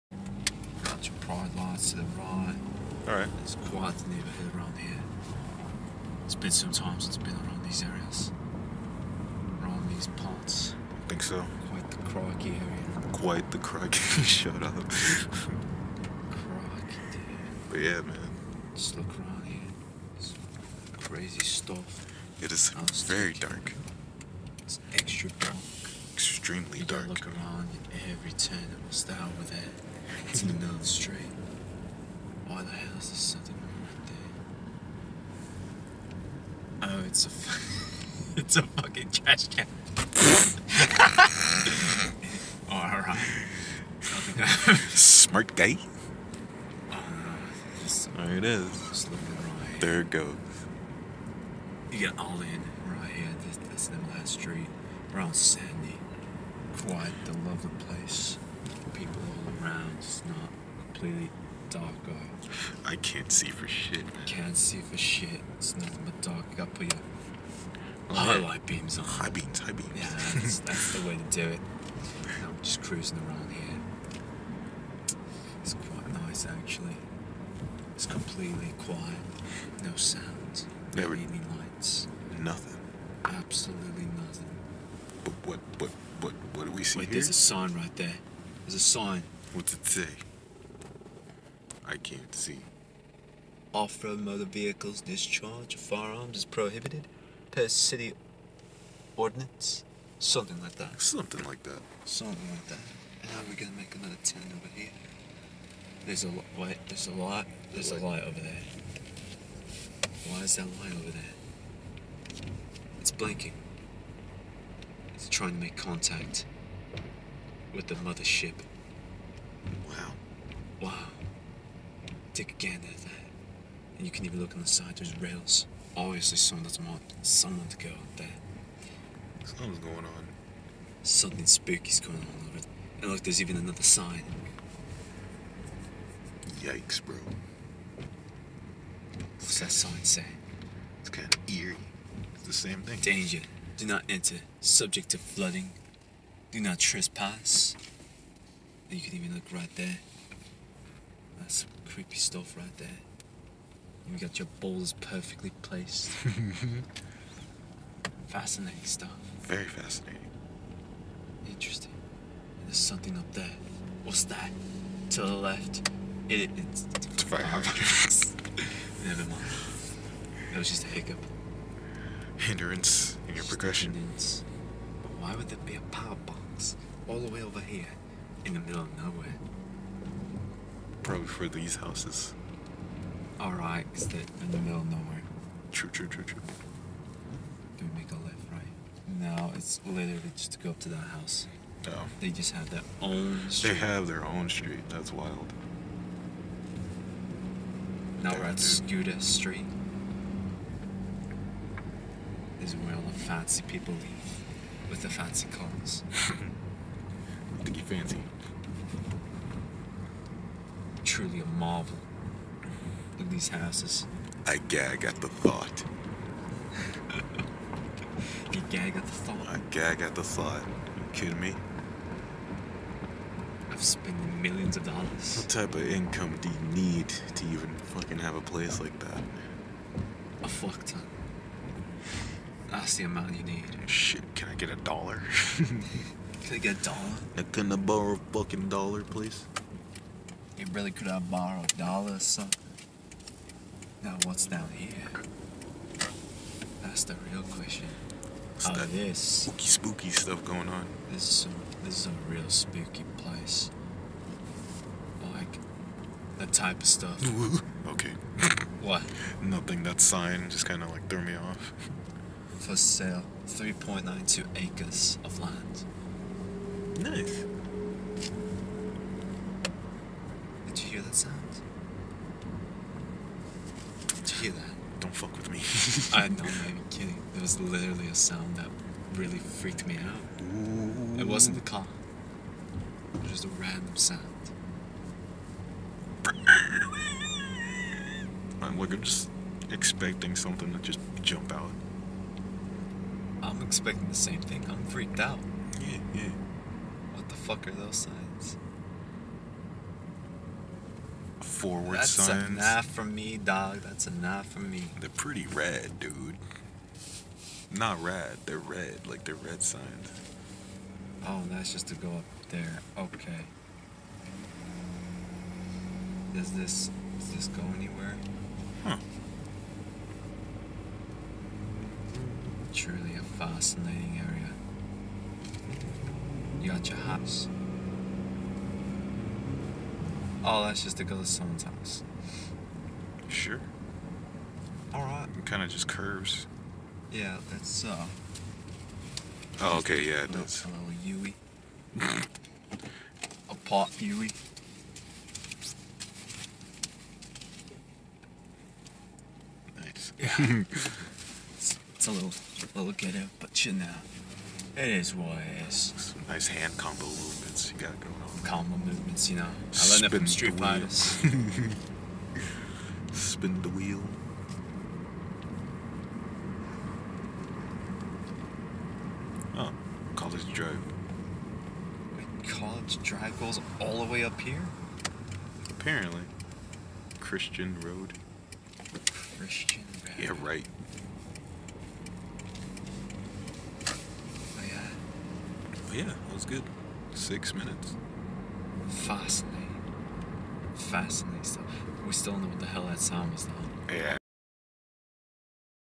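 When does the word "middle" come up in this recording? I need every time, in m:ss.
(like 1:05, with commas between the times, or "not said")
0:30, 2:58, 3:04.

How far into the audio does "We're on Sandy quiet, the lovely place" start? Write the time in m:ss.
0:55.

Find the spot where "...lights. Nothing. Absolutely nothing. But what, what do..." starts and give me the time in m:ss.
1:21.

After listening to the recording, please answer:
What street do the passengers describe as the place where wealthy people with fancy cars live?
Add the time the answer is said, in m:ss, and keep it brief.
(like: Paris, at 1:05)
Scooter Street, at 3:18.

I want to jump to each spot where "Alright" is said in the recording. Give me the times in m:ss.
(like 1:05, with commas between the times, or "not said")
0:03, 0:44, 3:03, 5:34.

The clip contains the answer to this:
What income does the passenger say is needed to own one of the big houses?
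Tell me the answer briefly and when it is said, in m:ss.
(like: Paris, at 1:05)
A fuck ton, at 3:50.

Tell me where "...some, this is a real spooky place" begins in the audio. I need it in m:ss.
4:11.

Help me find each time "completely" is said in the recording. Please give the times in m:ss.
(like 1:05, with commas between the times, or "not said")
1:00, 1:18.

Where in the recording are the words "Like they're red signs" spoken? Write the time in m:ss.
5:09.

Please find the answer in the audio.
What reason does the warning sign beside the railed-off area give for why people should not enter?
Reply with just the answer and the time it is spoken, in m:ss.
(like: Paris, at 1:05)
Subject to flooding, at 2:24.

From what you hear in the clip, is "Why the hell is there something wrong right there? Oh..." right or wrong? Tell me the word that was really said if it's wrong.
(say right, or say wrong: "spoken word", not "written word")
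right.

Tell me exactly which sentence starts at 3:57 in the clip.
I can I borrow a fucking dollar, please?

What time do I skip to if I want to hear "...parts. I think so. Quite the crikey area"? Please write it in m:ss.
0:10.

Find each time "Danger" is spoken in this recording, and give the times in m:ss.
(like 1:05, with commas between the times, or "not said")
2:22.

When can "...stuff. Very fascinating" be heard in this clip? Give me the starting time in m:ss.
2:38.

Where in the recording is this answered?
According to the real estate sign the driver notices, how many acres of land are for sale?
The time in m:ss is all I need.
4:23.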